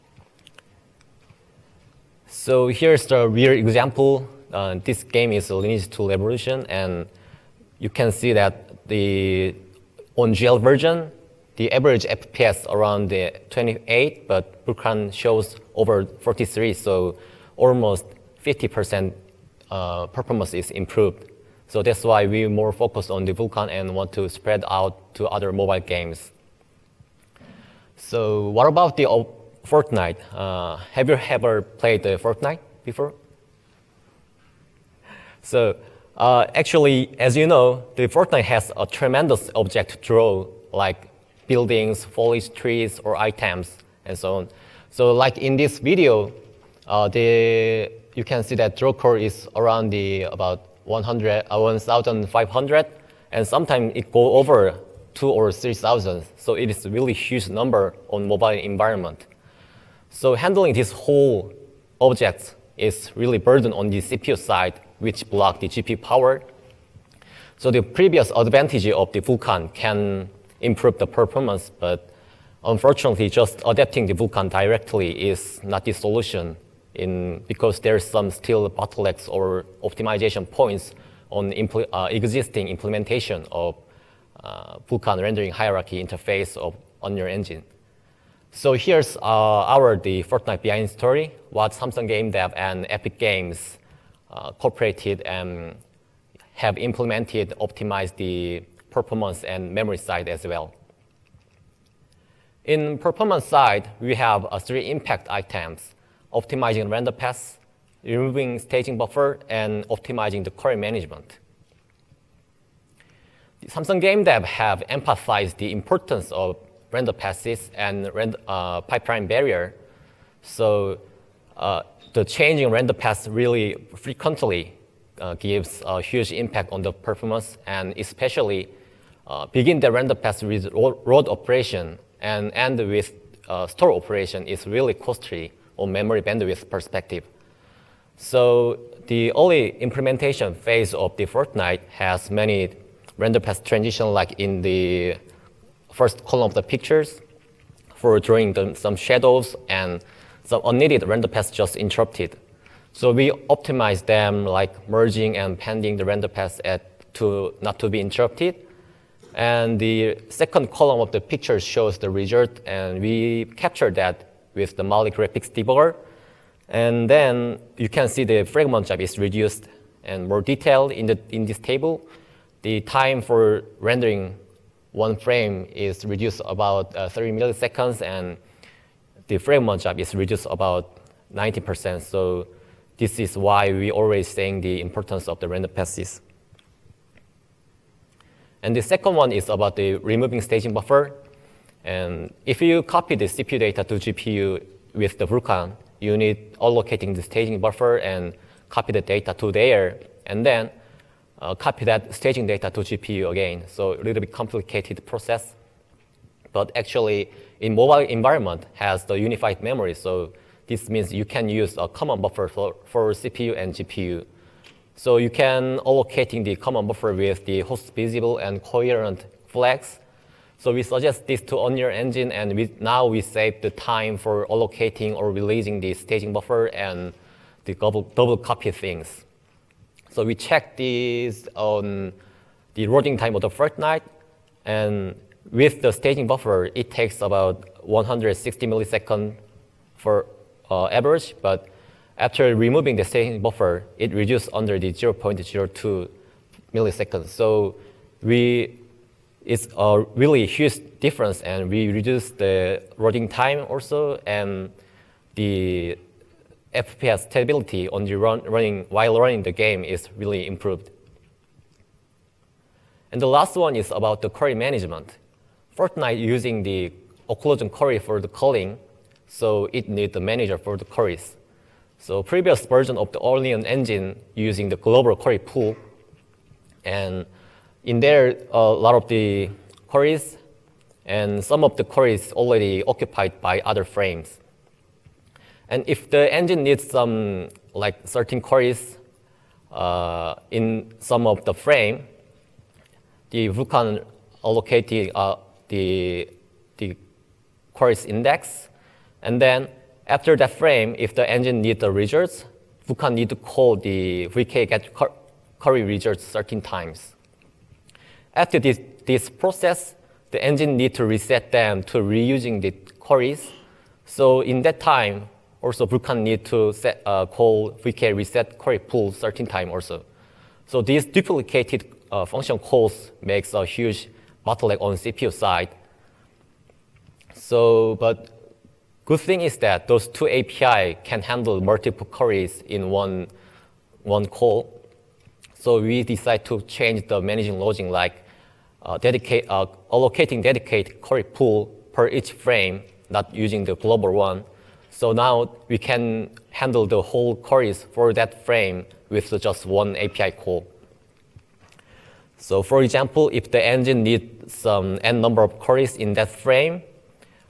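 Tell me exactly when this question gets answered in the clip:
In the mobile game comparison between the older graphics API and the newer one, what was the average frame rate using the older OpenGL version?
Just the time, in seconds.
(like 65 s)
12 s.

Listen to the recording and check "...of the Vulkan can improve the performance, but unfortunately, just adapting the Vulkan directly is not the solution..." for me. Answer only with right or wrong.
right.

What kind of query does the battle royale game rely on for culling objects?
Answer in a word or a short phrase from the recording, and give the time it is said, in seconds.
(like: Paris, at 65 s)
occlusion query, at 267 s.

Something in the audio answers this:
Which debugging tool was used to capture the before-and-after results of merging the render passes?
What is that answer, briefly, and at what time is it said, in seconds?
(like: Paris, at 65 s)
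Mali graphics debugger, at 164 s.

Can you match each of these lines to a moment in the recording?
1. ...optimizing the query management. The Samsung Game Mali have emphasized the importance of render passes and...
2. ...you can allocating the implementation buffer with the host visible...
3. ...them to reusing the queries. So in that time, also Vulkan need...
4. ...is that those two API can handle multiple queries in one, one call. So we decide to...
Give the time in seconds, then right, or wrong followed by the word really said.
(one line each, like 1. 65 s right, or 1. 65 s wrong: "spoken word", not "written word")
1. 109 s wrong: "Dev", not "Mali"
2. 215 s wrong: "common", not "implementation"
3. 311 s right
4. 329 s right.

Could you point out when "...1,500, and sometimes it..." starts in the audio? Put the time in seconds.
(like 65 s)
51 s.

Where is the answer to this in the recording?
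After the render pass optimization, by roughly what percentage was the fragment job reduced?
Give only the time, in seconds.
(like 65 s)
180 s.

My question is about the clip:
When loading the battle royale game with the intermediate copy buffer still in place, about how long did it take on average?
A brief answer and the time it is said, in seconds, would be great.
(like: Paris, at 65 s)
160 milliseconds, at 237 s.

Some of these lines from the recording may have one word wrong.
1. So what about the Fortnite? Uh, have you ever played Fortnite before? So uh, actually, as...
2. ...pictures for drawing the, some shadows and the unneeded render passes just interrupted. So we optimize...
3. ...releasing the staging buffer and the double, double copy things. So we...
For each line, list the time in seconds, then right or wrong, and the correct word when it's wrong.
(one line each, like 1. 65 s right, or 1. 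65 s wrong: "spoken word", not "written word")
1. 27 s right
2. 146 s right
3. 225 s right.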